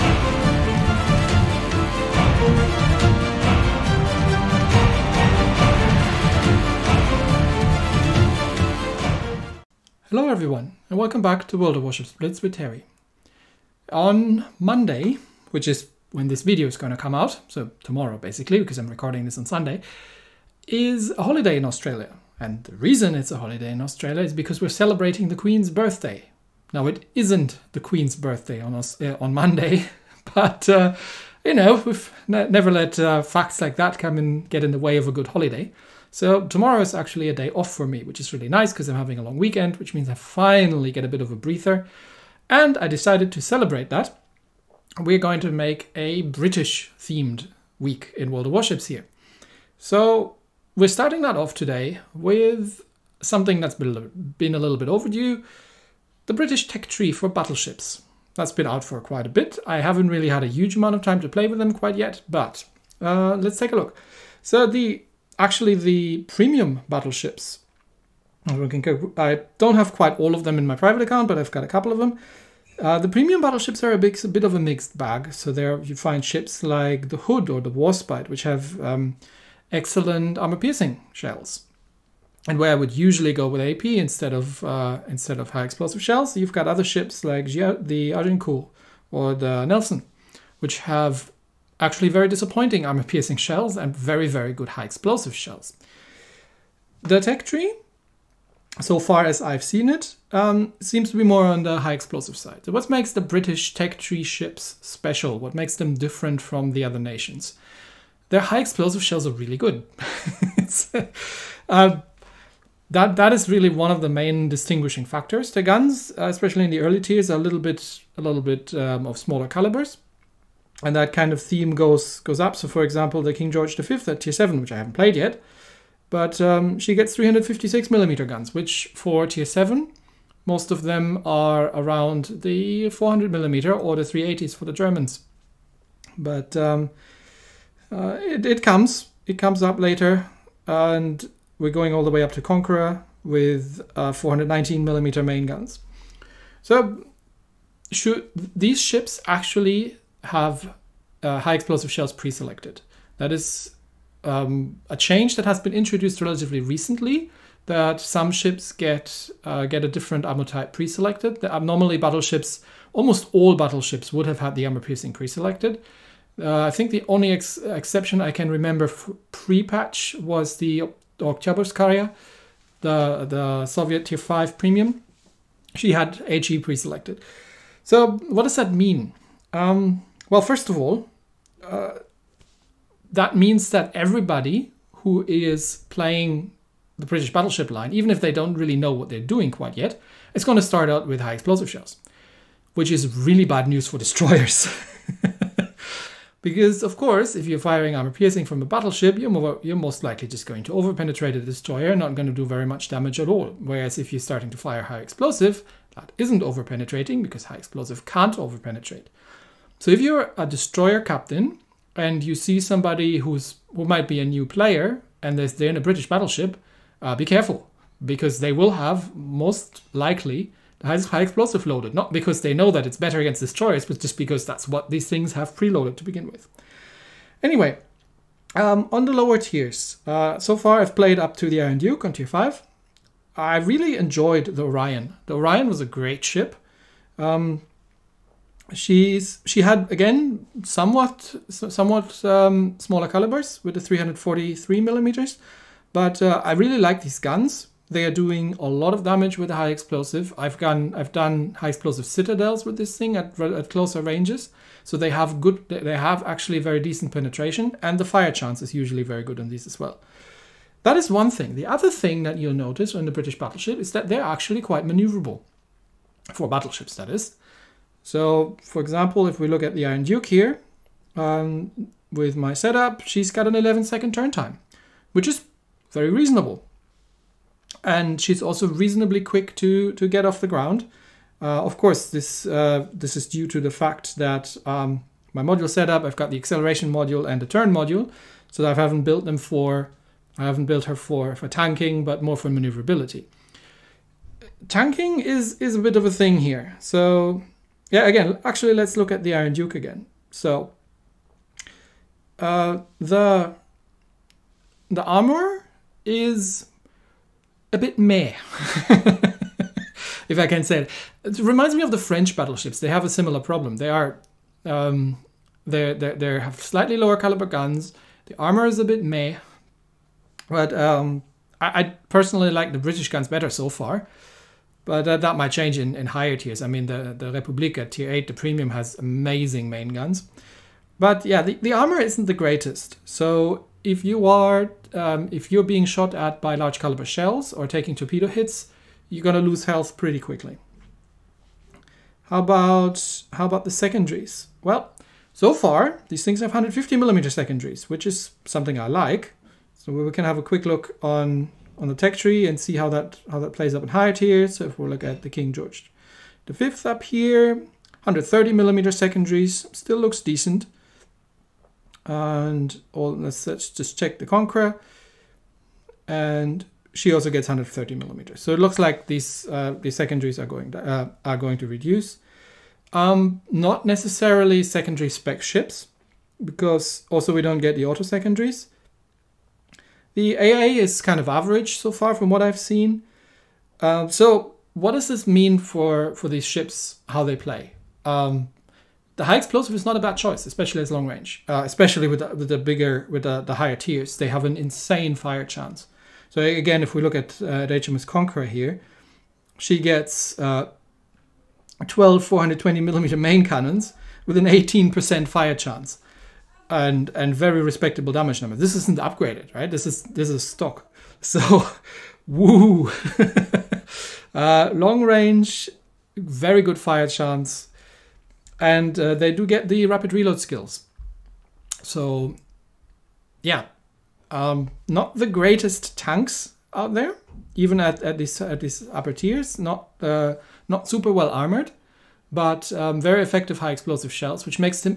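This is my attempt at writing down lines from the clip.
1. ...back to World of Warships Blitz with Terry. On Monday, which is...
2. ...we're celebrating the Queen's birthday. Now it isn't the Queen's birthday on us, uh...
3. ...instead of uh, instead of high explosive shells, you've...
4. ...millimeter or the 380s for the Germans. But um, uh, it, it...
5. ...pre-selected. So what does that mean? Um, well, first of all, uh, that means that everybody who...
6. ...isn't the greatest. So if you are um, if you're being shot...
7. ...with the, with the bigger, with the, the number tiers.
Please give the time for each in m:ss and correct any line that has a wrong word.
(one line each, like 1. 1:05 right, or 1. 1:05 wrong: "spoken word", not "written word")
1. 0:11 right
2. 0:24 right
3. 1:23 right
4. 2:13 right
5. 2:56 right
6. 5:31 right
7. 6:32 wrong: "higher", not "number".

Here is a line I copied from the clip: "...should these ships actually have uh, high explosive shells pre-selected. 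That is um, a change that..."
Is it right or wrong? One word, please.
right.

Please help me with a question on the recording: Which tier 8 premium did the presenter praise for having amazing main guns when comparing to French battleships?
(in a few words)
Republica.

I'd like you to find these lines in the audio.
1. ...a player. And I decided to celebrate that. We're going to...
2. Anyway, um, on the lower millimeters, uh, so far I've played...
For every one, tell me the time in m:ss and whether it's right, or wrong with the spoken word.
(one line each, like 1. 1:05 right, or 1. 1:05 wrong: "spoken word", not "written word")
1. 0:41 wrong: "breather", not "player"
2. 3:47 wrong: "tiers", not "millimeters".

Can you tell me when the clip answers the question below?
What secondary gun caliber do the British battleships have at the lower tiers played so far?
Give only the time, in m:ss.
5:46.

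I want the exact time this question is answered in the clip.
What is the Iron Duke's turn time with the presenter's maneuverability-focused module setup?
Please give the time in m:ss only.
4:33.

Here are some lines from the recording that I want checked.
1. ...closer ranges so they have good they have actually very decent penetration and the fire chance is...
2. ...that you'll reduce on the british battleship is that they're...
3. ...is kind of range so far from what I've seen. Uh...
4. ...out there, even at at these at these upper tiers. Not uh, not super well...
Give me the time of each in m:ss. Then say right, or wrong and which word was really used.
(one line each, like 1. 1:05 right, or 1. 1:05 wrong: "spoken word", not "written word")
1. 4:13 right
2. 4:22 wrong: "notice", not "reduce"
3. 6:20 wrong: "average", not "range"
4. 7:06 right.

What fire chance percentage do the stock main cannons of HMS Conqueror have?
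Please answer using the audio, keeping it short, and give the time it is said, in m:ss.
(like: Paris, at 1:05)
18%, at 6:44.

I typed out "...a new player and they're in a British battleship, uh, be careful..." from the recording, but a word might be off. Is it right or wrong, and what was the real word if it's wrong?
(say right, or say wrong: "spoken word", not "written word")
right.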